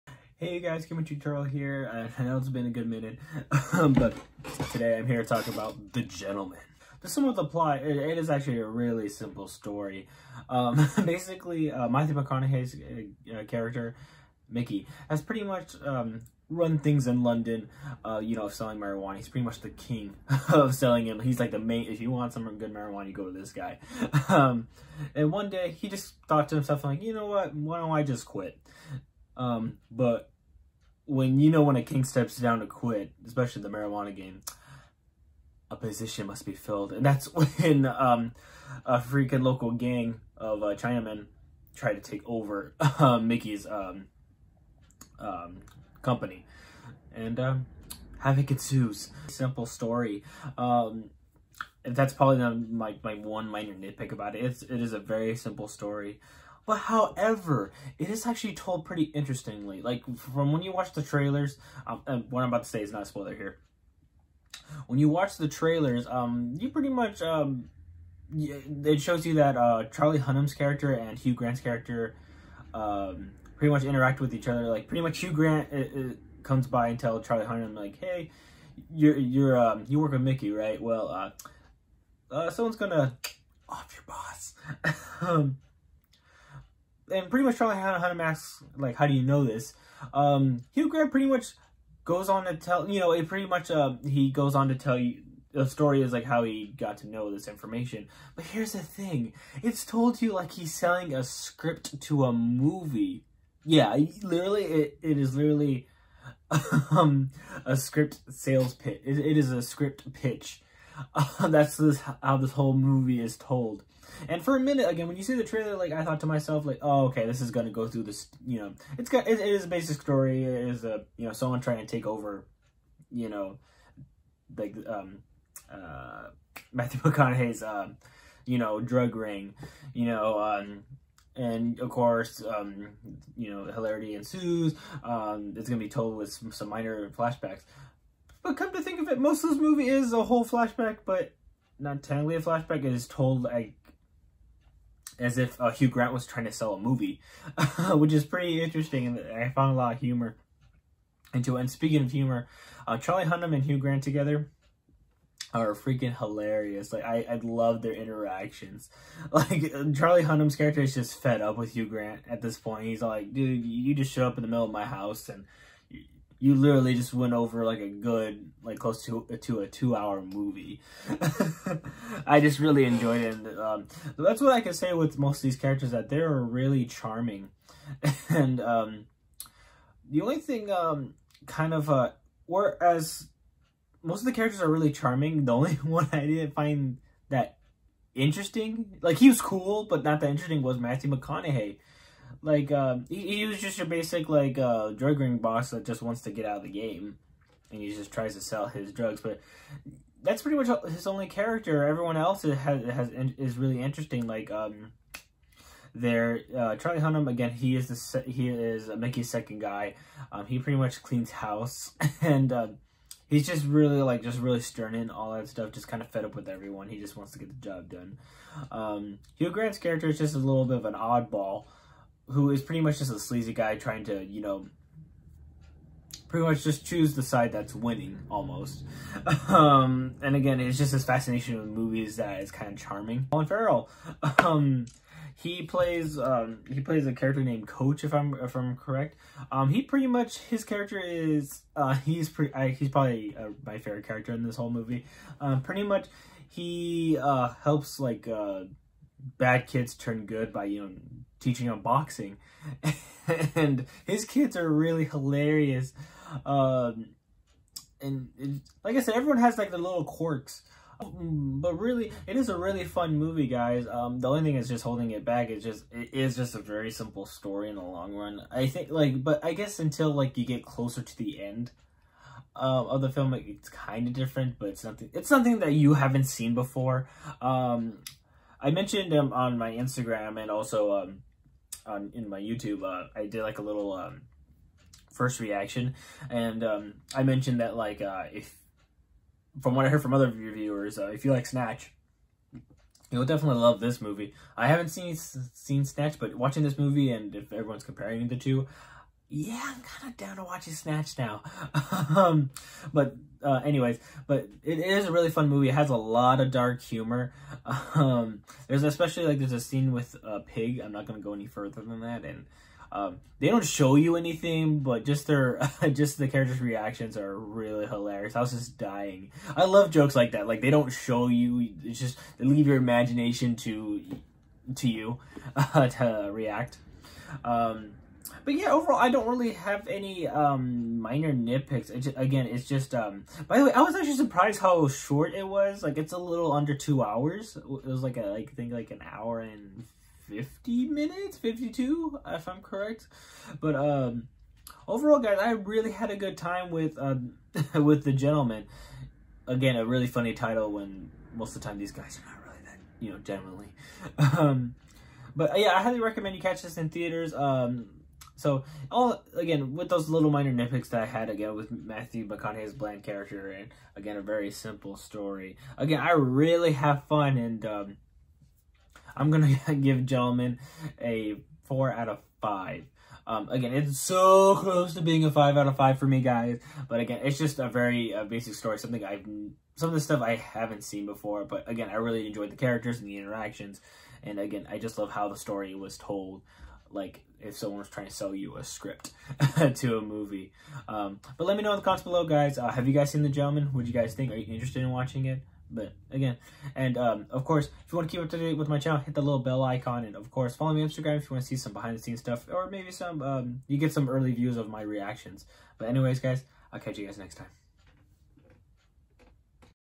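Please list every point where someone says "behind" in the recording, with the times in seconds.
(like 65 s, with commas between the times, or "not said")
401 s.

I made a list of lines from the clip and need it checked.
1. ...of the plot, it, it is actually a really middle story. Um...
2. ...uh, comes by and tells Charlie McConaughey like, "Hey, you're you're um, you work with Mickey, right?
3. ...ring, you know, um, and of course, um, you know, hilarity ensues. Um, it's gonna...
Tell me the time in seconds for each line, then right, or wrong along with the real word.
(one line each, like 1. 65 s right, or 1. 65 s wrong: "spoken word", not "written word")
1. 7 s wrong: "simple", not "middle"
2. 76 s wrong: "Hunnam", not "McConaughey"
3. 129 s right.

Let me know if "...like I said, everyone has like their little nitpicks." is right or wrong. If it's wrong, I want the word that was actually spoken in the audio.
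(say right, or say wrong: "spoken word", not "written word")
wrong: "quirks", not "nitpicks".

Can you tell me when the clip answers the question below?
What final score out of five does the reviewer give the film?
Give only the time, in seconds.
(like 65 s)
371 s.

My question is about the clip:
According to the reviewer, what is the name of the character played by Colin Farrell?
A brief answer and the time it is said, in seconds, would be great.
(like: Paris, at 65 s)
Coach, at 237 s.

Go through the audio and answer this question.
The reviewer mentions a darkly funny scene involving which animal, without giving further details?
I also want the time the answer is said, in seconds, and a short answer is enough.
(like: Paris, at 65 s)
A pig, at 310 s.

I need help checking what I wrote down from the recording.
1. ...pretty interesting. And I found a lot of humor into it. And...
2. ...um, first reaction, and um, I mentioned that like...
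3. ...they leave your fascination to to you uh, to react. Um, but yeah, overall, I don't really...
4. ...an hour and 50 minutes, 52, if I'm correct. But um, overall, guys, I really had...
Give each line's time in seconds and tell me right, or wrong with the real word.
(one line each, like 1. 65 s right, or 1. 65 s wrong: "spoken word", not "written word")
1. 148 s right
2. 283 s right
3. 322 s wrong: "imagination", not "fascination"
4. 338 s right.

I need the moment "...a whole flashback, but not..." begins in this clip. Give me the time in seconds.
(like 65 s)
140 s.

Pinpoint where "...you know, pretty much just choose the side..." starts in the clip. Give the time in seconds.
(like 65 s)
224 s.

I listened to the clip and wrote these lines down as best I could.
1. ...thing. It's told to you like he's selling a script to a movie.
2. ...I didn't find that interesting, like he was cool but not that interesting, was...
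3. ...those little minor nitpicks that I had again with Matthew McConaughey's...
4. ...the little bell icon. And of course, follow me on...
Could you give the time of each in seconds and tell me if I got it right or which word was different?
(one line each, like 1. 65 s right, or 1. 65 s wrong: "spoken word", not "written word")
1. 98 s right
2. 186 s right
3. 359 s right
4. 399 s right.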